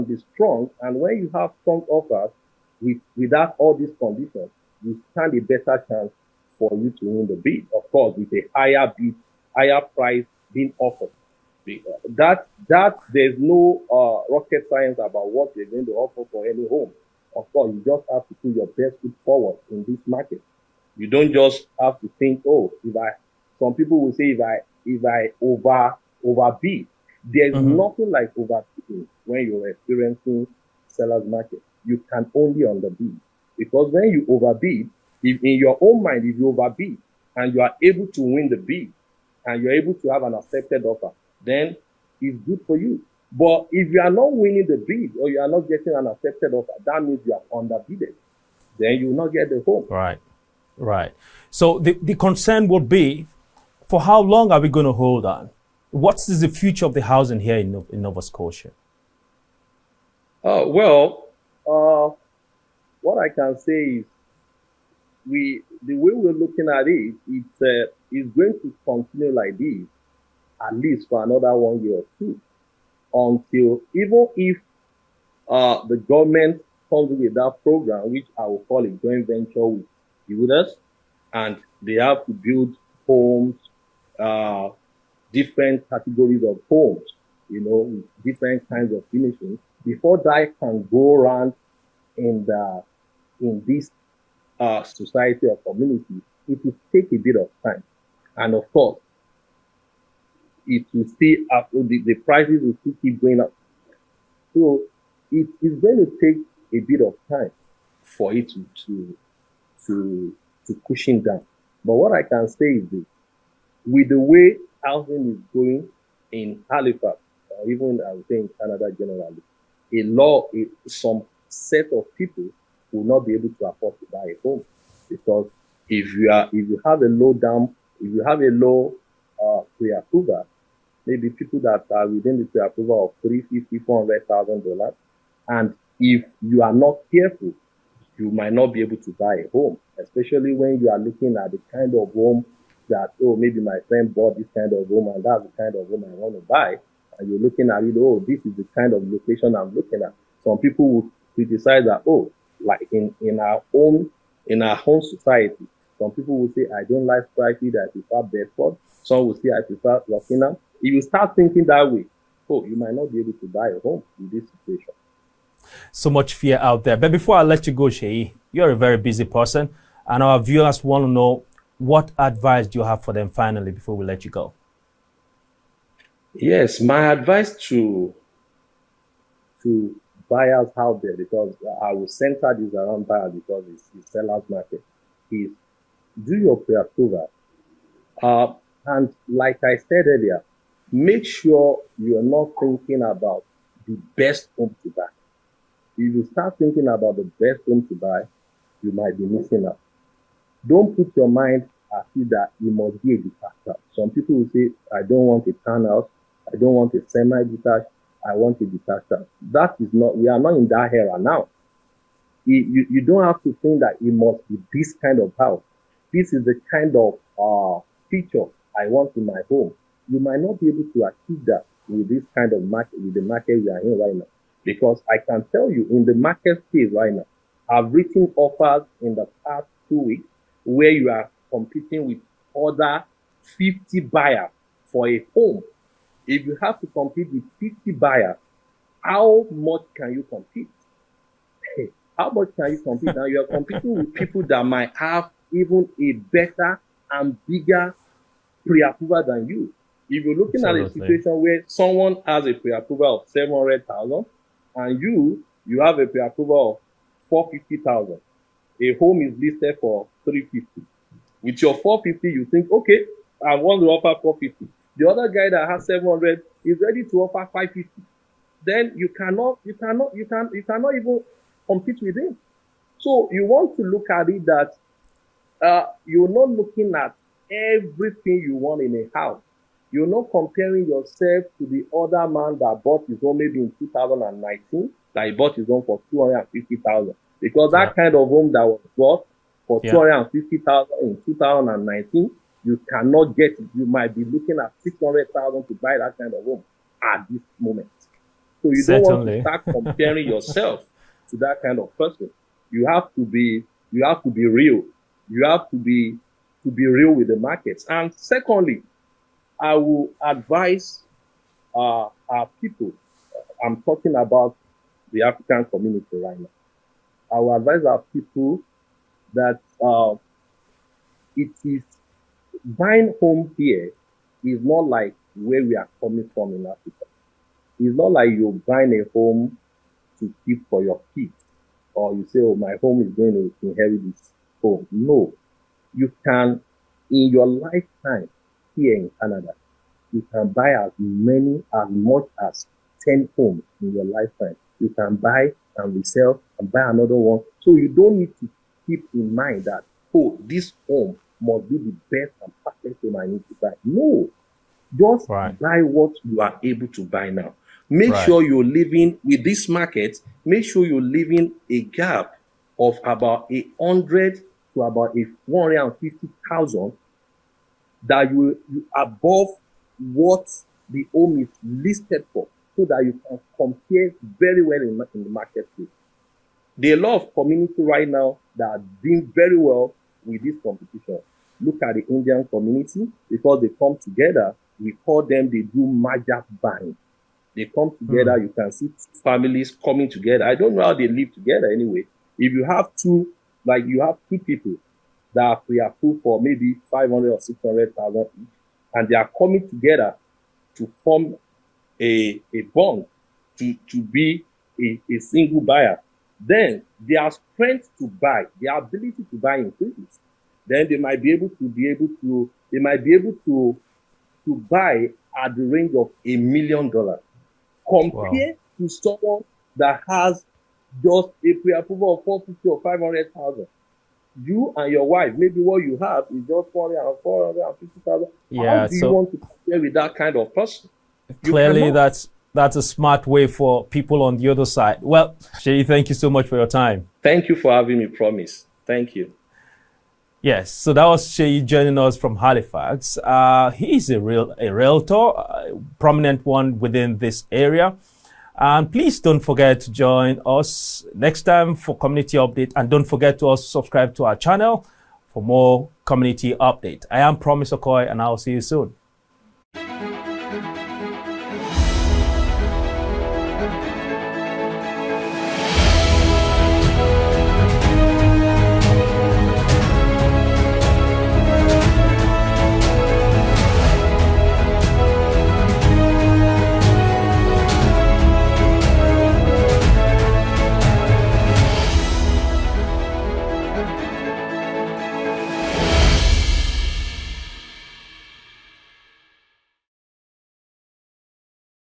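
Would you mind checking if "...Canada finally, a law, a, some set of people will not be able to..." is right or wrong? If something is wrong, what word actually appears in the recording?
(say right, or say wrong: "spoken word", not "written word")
wrong: "generally", not "finally".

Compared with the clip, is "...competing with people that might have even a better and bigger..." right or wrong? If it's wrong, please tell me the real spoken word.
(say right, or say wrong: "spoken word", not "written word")
right.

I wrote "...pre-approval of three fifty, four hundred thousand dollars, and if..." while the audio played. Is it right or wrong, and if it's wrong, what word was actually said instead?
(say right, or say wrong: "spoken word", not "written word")
right.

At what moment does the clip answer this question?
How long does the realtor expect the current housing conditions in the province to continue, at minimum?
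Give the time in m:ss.
1:11.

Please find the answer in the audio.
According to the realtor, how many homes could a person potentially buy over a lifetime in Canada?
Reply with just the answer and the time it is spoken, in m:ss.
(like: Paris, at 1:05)
10, at 5:43.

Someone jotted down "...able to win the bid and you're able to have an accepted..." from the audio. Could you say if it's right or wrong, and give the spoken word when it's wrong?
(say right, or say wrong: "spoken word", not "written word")
right.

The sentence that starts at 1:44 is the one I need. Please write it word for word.
So it is going to take a bit of time for it to to to, to cushion down.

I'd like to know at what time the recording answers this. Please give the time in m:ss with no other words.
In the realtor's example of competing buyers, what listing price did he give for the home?
4:20.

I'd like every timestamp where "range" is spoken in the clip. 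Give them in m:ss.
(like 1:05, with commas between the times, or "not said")
6:55.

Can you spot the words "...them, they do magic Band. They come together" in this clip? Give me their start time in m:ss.
6:25.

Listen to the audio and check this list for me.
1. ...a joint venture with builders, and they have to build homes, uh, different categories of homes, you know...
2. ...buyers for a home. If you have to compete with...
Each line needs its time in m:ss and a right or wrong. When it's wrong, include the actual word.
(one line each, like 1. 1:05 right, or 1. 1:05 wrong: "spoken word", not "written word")
1. 1:18 right
2. 3:54 right.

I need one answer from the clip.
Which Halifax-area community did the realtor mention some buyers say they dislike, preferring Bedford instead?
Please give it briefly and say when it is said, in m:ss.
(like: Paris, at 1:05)
Stratford, at 2:37.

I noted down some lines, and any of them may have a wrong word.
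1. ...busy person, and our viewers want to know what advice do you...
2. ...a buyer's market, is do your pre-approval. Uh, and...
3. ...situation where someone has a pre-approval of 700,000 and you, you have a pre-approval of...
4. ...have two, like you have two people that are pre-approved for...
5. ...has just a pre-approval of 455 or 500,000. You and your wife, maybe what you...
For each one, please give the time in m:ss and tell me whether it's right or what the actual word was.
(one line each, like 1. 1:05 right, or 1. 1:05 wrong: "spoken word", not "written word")
1. 2:48 right
2. 3:03 wrong: "seller", not "buyer"
3. 4:10 right
4. 6:32 right
5. 7:00 wrong: "450", not "455".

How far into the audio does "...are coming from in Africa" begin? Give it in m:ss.
5:25.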